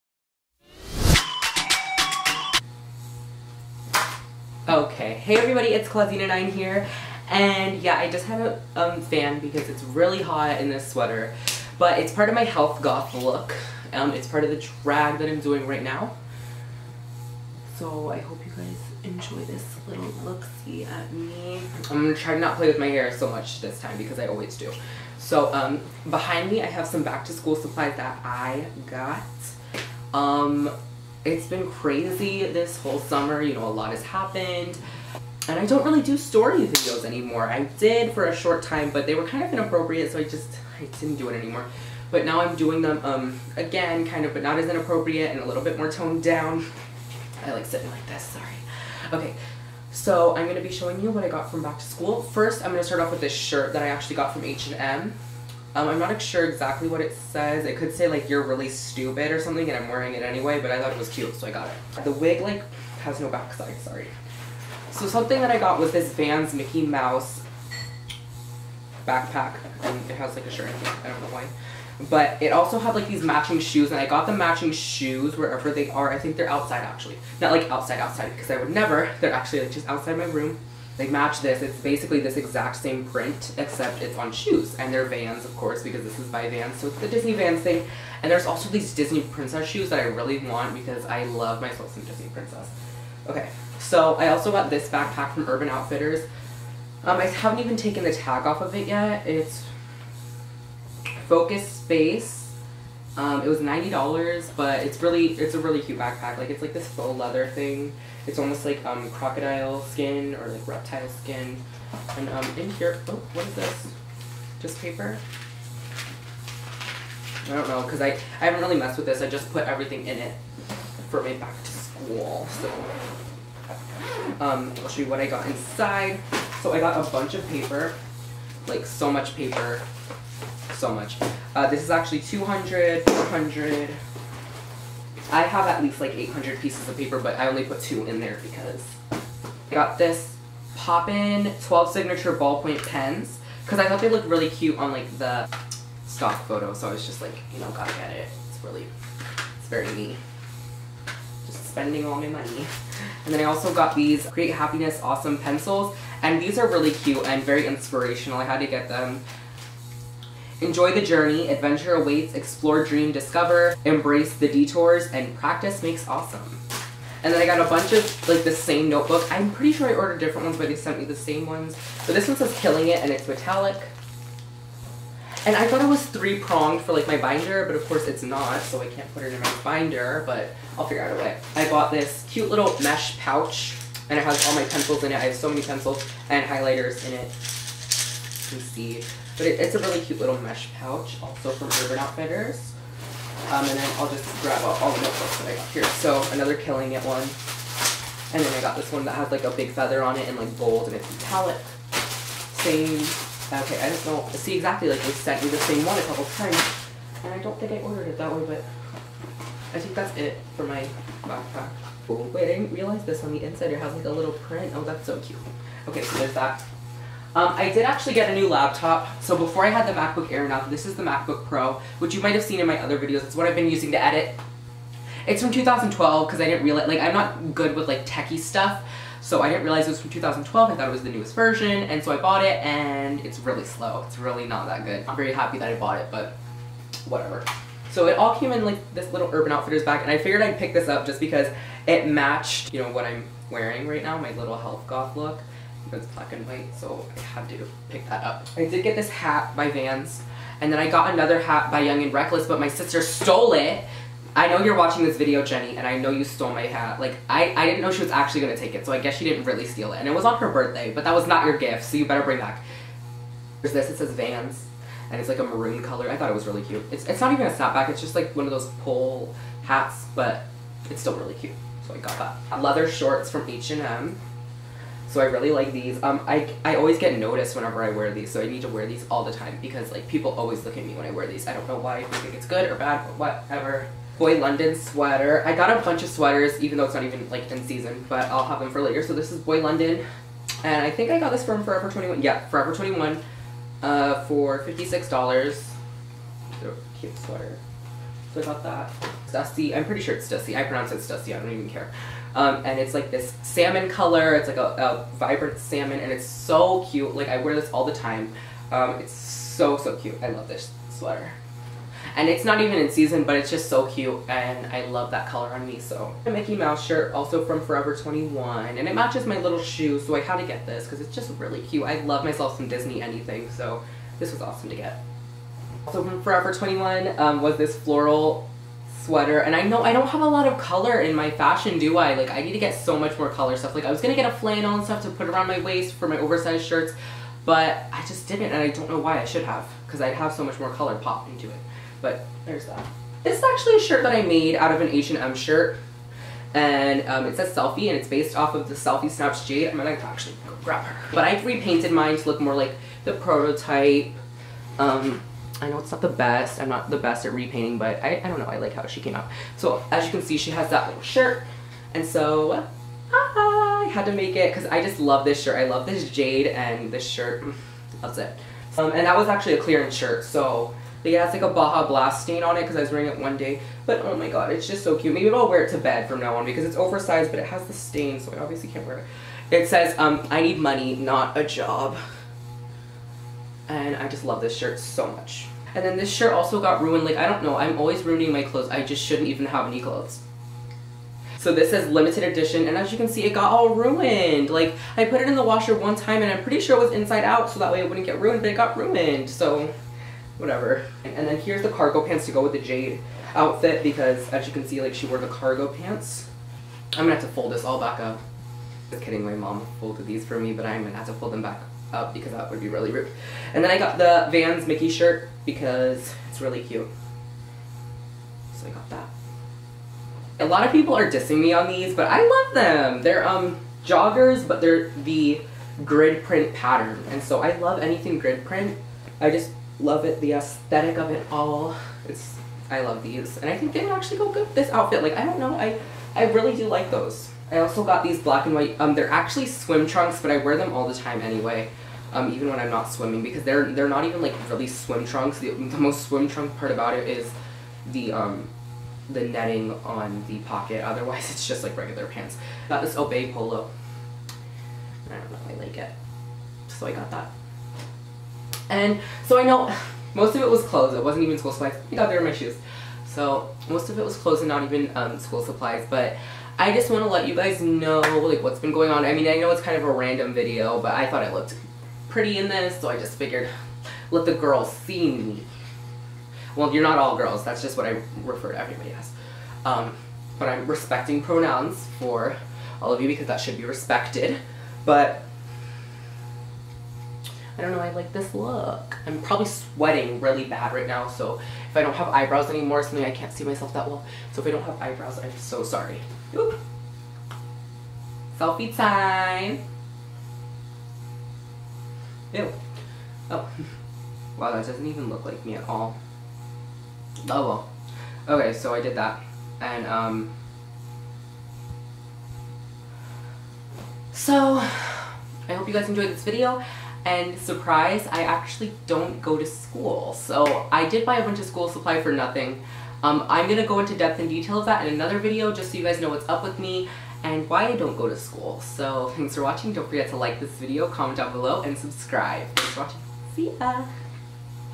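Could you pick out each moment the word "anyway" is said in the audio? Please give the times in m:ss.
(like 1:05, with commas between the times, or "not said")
1:00, 7:21.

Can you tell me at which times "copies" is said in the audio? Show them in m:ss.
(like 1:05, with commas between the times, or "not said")
not said.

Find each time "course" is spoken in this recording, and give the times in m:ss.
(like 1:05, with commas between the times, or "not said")
1:25, 2:57.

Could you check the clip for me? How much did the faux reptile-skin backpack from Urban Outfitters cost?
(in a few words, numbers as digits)
$90.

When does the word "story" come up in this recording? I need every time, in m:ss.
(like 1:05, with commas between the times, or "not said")
0:36.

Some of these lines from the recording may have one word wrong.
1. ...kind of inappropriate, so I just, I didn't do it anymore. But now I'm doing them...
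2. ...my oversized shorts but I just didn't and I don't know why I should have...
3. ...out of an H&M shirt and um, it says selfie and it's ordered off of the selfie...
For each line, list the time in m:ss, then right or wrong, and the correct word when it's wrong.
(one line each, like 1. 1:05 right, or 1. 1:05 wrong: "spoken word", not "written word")
1. 0:39 right
2. 5:36 wrong: "shirts", not "shorts"
3. 5:44 wrong: "based", not "ordered".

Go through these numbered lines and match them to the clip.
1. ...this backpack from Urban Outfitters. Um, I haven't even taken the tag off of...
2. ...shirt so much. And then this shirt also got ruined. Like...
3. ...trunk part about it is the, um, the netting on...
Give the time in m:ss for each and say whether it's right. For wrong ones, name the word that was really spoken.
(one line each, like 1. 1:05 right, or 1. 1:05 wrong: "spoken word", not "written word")
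1. 1:34 right
2. 6:24 right
3. 7:26 right.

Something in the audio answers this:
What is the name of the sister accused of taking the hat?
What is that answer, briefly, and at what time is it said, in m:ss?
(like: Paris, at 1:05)
Jenny, at 4:15.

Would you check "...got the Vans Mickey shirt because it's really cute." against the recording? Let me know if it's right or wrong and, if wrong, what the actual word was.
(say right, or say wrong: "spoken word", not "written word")
right.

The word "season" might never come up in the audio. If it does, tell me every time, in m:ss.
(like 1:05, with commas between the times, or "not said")
4:47, 5:12.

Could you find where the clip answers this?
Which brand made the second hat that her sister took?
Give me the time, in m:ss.
4:11.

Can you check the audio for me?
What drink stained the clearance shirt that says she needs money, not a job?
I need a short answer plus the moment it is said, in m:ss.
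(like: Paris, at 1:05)
Baja Blast, at 6:11.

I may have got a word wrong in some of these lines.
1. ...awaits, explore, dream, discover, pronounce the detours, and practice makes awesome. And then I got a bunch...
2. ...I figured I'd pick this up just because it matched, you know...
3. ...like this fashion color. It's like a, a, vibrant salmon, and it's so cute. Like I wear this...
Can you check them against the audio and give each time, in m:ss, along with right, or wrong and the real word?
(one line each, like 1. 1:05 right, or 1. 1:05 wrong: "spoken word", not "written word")
1. 2:41 wrong: "embrace", not "pronounce"
2. 4:00 right
3. 5:02 wrong: "salmon", not "fashion".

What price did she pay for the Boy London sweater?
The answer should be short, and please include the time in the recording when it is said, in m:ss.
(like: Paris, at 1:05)
$56, at 4:54.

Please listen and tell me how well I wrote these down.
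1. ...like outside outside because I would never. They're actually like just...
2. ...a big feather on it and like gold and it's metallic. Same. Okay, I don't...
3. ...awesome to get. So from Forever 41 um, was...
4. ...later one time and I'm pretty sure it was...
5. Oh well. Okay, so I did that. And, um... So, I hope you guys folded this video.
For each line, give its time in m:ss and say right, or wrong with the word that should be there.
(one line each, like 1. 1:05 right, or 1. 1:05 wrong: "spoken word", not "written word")
1. 1:17 right
2. 3:19 right
3. 5:24 wrong: "21", not "41"
4. 6:35 wrong: "washer", not "later"
5. 8:27 wrong: "enjoyed", not "folded".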